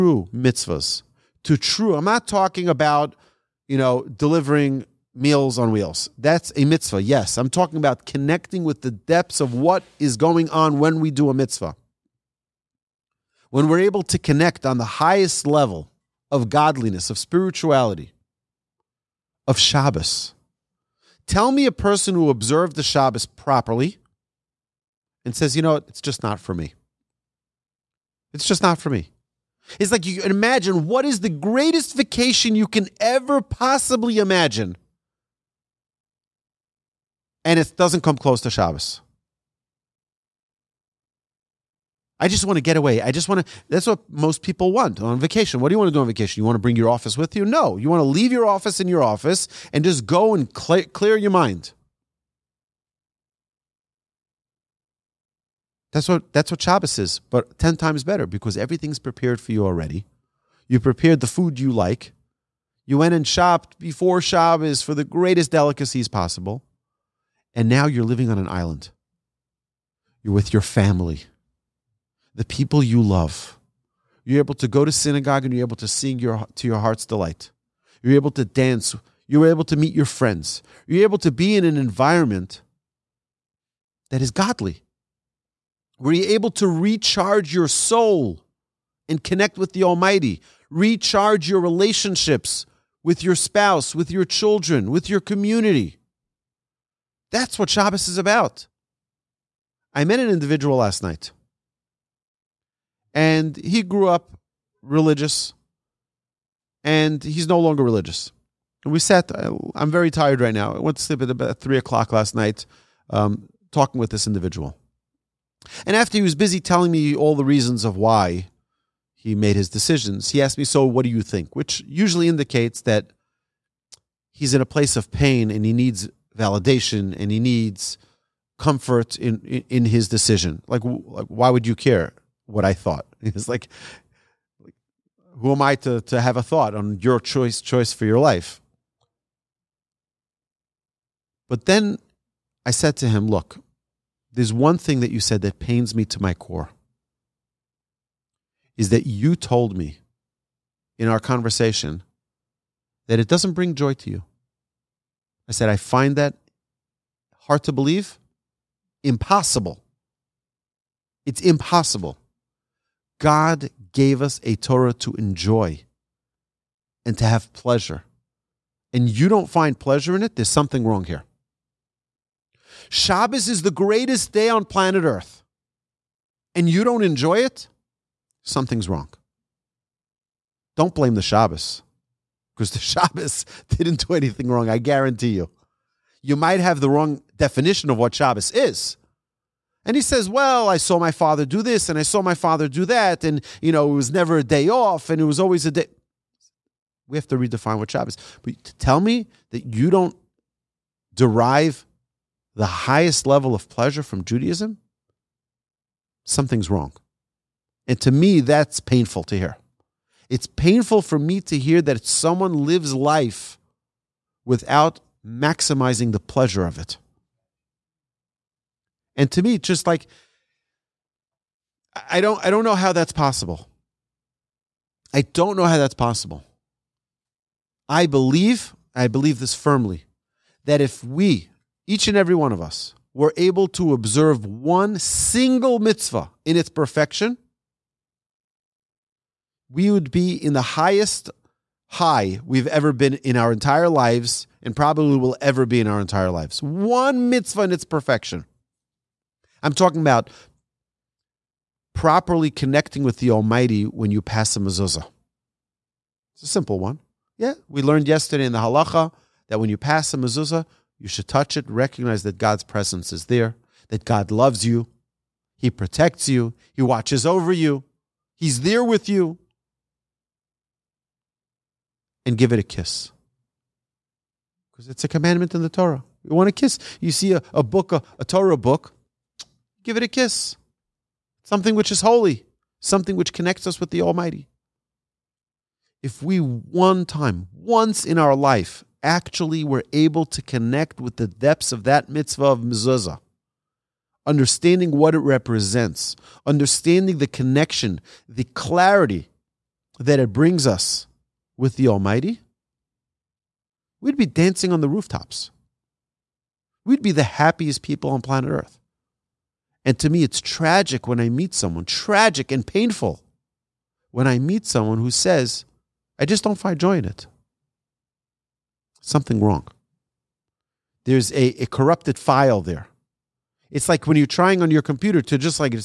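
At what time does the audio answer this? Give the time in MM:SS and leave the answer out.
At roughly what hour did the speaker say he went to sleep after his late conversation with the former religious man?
01:51.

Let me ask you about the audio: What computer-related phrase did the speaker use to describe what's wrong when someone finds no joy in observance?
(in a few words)
a corrupted file.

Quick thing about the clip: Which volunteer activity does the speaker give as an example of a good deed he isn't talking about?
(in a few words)
delivering meals on wheels.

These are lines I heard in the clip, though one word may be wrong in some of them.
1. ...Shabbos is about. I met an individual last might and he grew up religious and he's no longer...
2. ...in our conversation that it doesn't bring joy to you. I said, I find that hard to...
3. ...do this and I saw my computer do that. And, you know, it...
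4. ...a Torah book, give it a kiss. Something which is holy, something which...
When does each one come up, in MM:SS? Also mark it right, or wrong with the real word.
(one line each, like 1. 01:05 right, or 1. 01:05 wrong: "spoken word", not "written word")
1. 01:37 wrong: "night", not "might"
2. 02:30 right
3. 03:11 wrong: "father", not "computer"
4. 04:38 right.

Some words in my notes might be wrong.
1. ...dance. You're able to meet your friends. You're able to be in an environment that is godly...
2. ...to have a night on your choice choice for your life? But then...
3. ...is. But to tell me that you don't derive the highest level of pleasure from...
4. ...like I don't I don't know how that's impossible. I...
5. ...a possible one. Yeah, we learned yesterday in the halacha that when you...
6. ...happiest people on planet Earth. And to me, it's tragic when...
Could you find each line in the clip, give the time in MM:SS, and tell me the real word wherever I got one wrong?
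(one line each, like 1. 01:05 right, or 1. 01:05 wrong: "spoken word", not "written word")
1. 01:18 right
2. 02:16 wrong: "thought", not "night"
3. 03:18 right
4. 03:39 wrong: "possible", not "impossible"
5. 04:16 wrong: "simple", not "possible"
6. 05:07 right.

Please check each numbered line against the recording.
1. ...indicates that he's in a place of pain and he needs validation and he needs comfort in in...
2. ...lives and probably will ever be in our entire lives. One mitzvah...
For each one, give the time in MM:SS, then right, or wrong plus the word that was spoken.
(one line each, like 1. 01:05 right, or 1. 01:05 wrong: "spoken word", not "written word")
1. 02:02 right
2. 04:03 right.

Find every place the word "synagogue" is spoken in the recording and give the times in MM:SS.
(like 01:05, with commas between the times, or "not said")
01:14.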